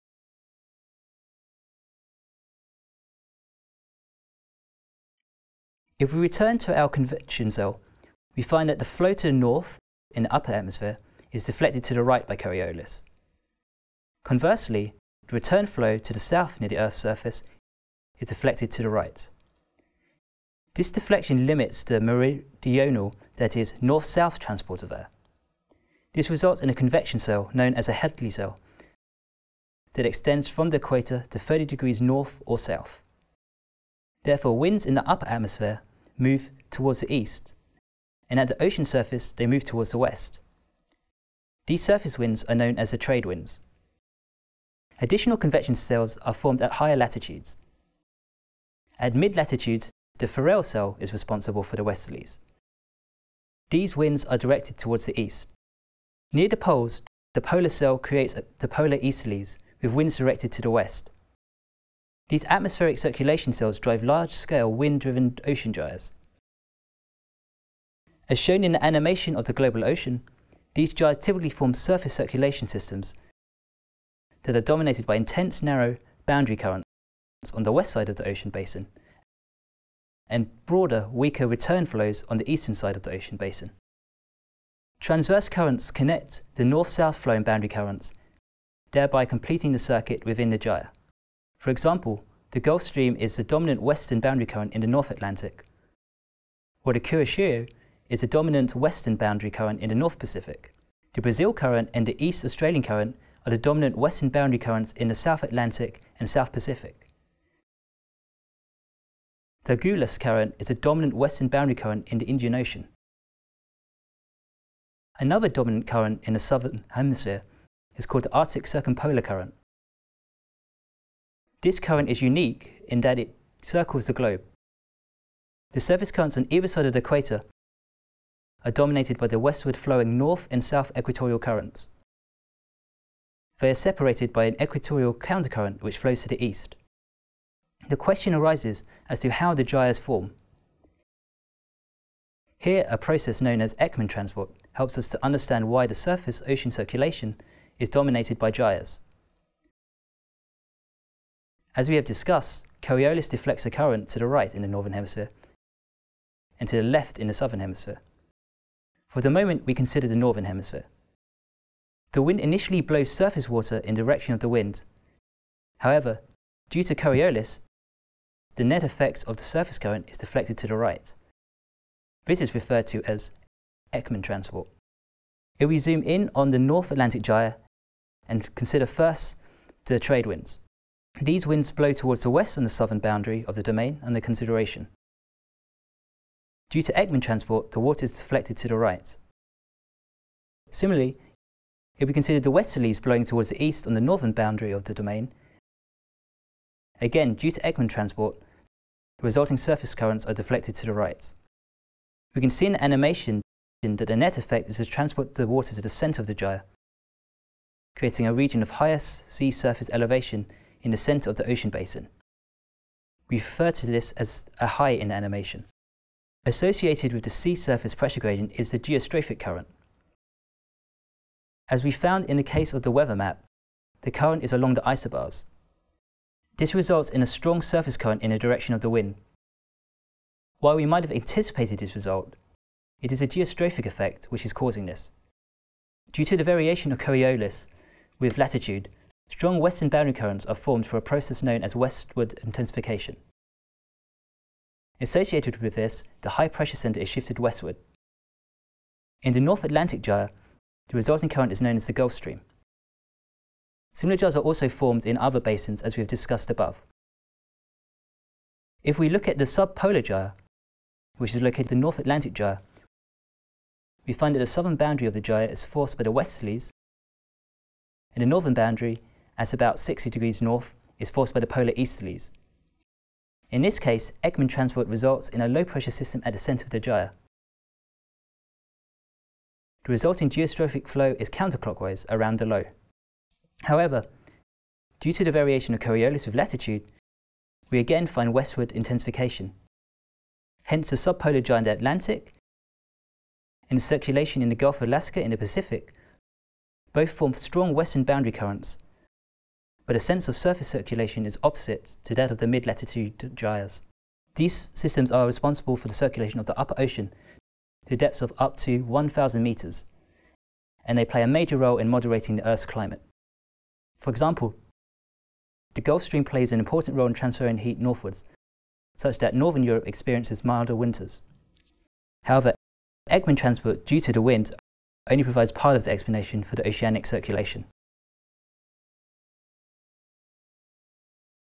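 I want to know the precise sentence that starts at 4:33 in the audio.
In this case, Ekman transport results in a low-pressure system at the centre of the gyre.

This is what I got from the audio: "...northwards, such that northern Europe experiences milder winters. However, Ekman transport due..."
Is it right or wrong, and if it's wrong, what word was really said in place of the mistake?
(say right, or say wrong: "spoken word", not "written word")
right.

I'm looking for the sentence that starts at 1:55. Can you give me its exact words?
Another dominant current in the southern hemisphere is called the Arctic Circumpolar Current.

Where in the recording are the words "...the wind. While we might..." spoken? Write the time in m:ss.
3:48.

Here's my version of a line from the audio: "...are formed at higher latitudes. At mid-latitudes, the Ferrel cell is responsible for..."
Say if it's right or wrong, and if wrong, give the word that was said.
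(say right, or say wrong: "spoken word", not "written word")
right.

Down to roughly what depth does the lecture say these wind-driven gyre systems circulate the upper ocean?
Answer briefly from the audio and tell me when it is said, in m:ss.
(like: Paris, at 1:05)
1,000 metres, at 5:08.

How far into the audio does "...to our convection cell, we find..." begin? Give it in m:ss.
0:06.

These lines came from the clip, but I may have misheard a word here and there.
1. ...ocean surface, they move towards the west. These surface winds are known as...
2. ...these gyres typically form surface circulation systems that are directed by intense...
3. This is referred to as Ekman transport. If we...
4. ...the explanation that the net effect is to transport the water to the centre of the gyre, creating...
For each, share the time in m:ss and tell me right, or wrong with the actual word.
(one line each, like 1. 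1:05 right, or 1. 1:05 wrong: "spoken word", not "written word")
1. 0:38 right
2. 1:10 wrong: "dominated", not "directed"
3. 2:52 right
4. 3:22 wrong: "animation", not "explanation".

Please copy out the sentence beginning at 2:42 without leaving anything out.
The wind initially blows surface water in the direction of the wind.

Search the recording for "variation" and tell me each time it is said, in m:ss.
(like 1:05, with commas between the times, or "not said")
3:56, 4:45.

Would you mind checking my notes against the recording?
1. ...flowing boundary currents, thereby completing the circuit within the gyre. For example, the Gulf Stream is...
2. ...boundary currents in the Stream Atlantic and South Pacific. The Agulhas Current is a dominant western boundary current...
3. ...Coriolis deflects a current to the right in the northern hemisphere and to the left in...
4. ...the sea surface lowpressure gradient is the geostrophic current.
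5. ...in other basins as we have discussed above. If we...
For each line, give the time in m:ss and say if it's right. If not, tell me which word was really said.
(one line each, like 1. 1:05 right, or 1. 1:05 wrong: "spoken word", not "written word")
1. 1:27 right
2. 1:44 wrong: "South", not "Stream"
3. 2:32 right
4. 3:37 wrong: "pressure", not "lowpressure"
5. 4:15 right.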